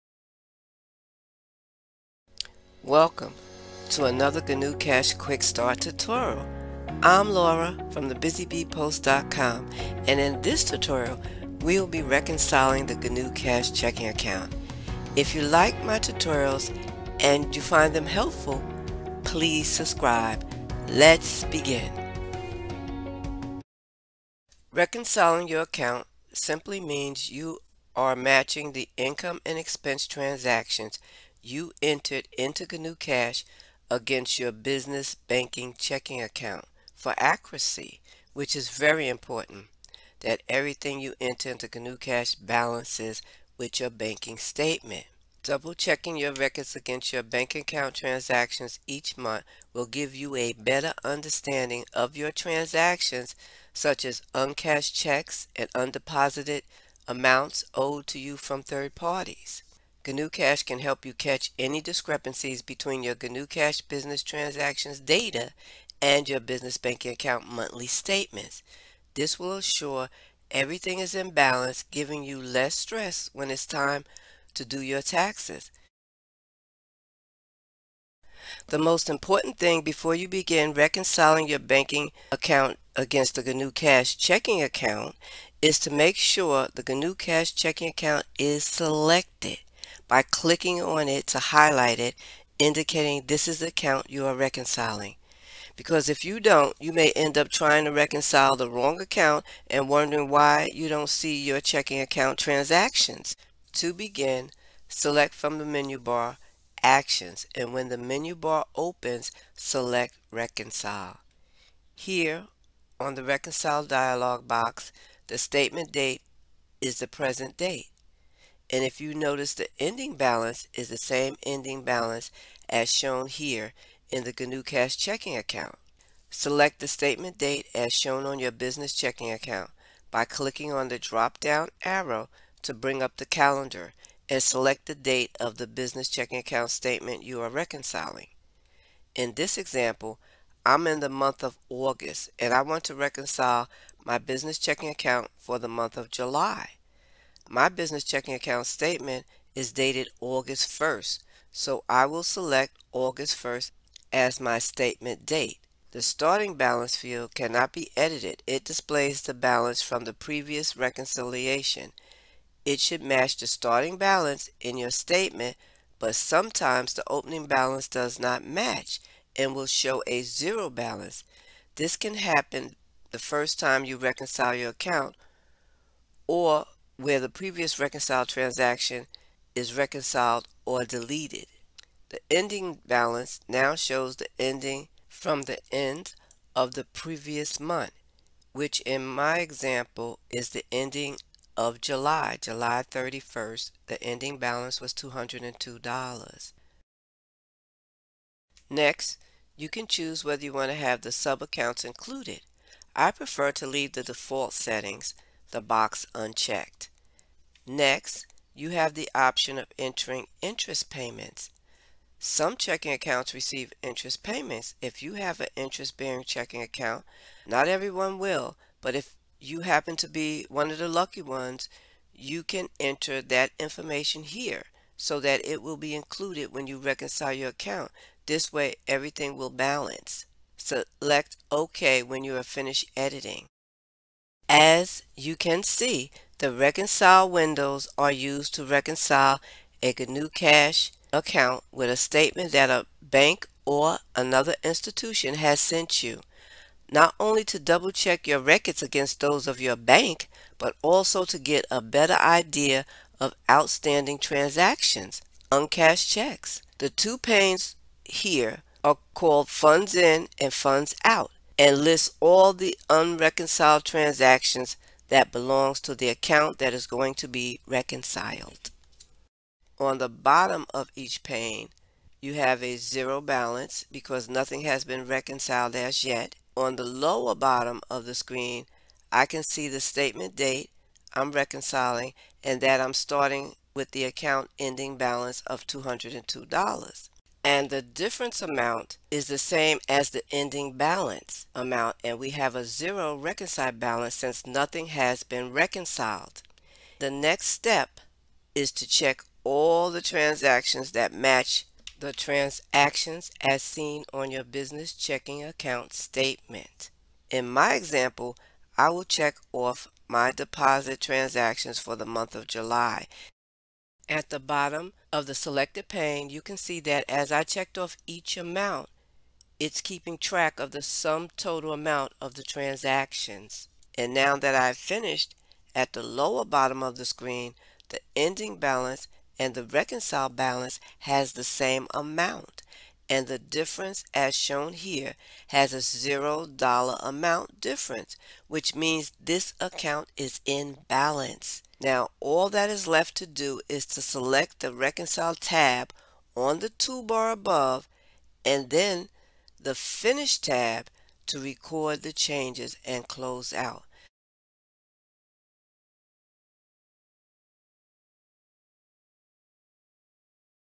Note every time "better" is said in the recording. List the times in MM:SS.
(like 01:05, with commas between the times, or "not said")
00:50, 04:11.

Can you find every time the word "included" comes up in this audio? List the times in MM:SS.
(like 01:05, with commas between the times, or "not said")
03:21, 03:45.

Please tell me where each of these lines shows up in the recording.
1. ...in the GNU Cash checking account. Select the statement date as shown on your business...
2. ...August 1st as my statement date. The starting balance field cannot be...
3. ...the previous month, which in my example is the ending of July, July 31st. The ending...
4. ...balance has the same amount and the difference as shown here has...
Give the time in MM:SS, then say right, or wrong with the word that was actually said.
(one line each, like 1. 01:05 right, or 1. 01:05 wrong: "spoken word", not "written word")
1. 02:04 right
2. 02:32 right
3. 03:06 right
4. 05:30 right.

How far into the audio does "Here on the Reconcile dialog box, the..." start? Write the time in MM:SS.
01:51.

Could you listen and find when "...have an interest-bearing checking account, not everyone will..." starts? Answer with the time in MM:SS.
03:35.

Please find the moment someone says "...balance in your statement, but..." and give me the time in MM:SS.
02:43.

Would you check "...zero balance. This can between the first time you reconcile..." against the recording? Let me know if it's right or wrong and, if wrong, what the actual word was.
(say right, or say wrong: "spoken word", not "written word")
wrong: "happen", not "between".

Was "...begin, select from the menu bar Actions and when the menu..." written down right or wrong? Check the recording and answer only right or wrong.
right.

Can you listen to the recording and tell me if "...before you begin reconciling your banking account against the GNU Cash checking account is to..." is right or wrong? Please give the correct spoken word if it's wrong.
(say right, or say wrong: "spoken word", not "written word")
right.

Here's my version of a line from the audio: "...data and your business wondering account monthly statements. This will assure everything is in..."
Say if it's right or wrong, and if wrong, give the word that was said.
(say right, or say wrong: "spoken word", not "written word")
wrong: "banking", not "wondering".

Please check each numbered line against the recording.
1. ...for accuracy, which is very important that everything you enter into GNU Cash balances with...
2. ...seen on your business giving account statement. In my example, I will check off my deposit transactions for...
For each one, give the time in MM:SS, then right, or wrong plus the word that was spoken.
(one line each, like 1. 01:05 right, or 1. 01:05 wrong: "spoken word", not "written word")
1. 00:36 right
2. 05:03 wrong: "checking", not "giving".